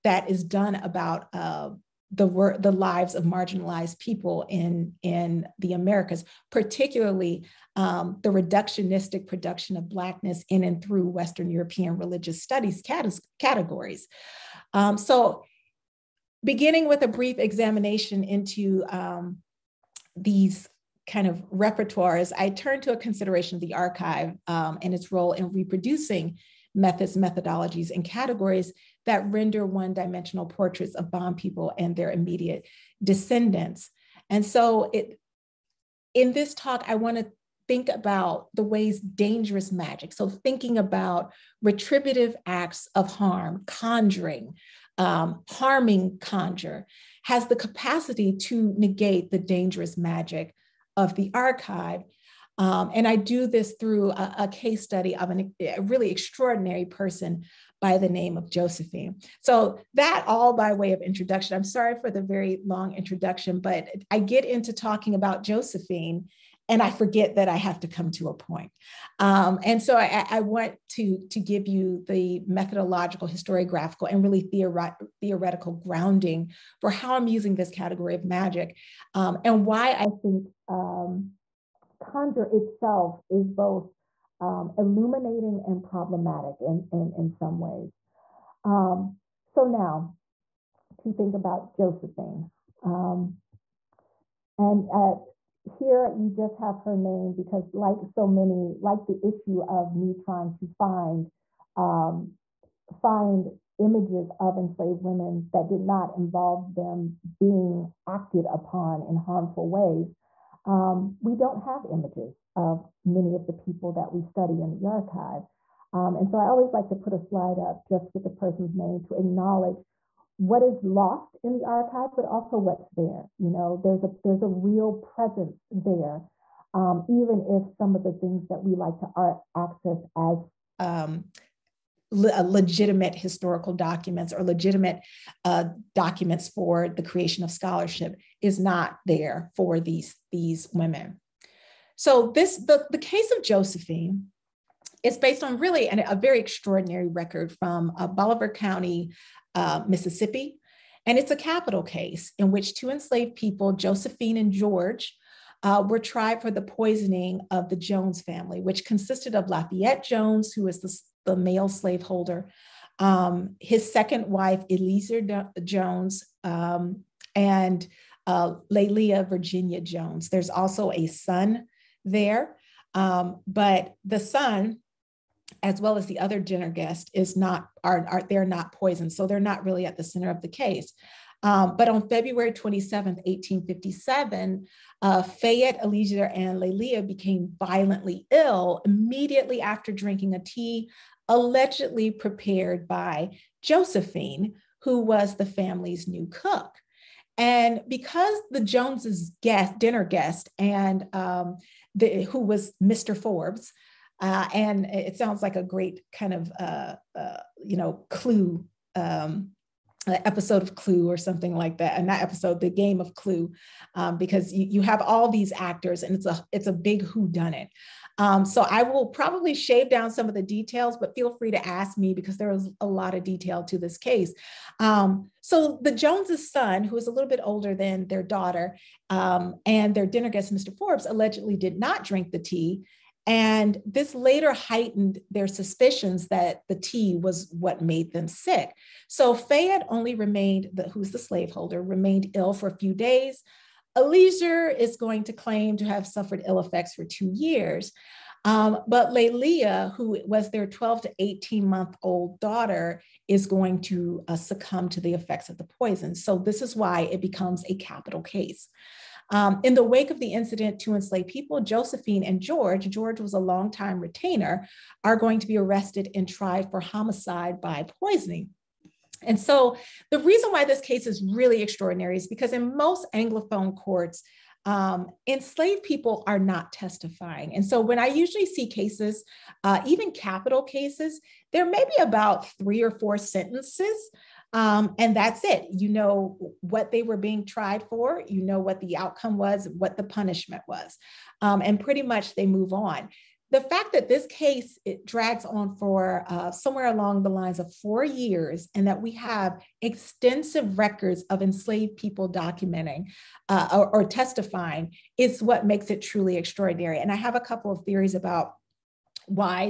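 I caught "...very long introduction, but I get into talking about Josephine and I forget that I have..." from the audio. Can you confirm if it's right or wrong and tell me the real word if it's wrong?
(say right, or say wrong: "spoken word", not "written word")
right.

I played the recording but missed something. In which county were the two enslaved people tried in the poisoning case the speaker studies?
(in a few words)
Bolivar County.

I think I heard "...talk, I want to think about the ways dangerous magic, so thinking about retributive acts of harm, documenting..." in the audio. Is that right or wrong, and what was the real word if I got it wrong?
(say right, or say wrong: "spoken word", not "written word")
wrong: "conjuring", not "documenting".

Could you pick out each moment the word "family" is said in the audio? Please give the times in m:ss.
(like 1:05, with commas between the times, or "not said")
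2:38, 3:15.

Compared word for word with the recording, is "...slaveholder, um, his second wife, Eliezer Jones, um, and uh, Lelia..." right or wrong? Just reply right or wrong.
right.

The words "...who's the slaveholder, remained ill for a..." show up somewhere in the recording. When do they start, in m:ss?
4:00.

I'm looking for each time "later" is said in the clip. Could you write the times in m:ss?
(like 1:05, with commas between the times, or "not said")
3:54.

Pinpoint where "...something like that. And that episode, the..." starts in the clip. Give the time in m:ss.
3:31.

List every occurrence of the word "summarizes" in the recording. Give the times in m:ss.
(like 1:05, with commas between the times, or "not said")
not said.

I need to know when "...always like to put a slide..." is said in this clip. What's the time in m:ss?
1:56.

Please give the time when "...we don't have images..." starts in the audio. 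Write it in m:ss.
1:51.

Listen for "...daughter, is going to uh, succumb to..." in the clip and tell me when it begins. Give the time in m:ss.
4:12.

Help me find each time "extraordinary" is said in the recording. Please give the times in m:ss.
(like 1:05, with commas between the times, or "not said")
0:56, 2:26, 4:31, 5:06.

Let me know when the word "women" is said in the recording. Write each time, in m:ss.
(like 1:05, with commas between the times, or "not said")
1:45, 2:20.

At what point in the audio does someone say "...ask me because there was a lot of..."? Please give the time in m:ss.
3:41.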